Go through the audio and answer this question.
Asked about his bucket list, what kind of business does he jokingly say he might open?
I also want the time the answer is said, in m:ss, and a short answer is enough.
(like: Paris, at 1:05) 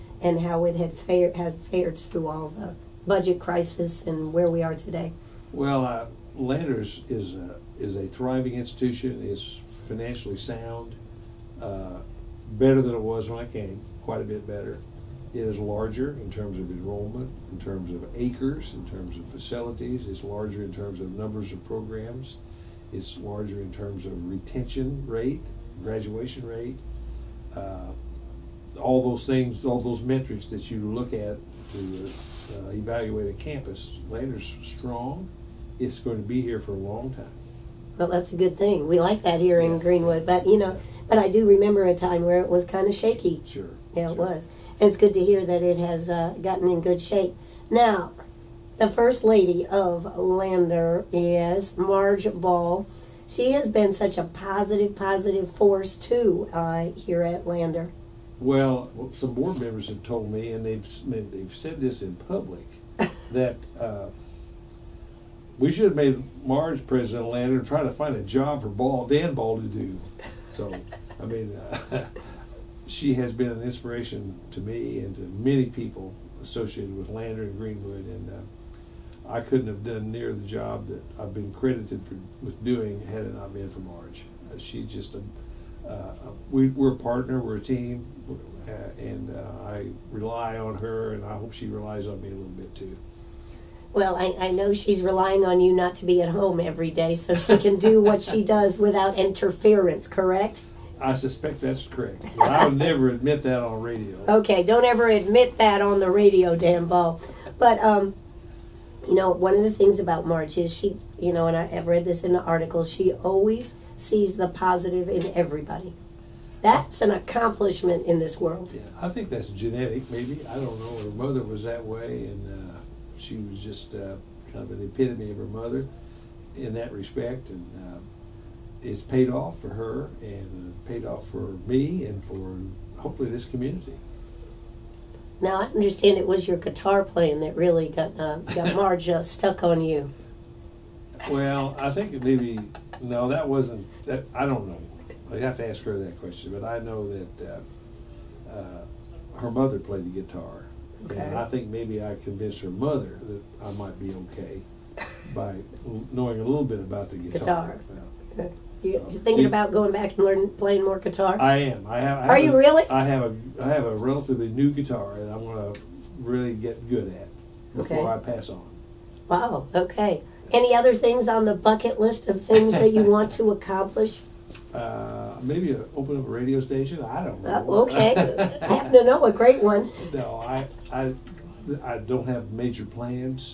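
a radio station, at 2:56.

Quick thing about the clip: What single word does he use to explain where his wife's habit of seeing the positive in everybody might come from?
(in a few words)
genetic.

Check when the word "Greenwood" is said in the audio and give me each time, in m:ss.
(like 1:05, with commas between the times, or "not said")
0:39, 1:17.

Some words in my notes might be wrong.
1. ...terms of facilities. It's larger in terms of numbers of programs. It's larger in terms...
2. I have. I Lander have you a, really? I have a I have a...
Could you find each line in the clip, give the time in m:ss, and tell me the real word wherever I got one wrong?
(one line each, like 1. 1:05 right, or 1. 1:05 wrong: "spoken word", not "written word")
1. 0:18 right
2. 2:41 wrong: "Are", not "Lander".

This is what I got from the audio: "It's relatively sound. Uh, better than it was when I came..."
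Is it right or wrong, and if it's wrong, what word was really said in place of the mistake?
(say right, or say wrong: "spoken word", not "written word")
wrong: "financially", not "relatively".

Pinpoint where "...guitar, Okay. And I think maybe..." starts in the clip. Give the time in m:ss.
2:30.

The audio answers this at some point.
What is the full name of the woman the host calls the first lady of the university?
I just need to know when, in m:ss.
0:51.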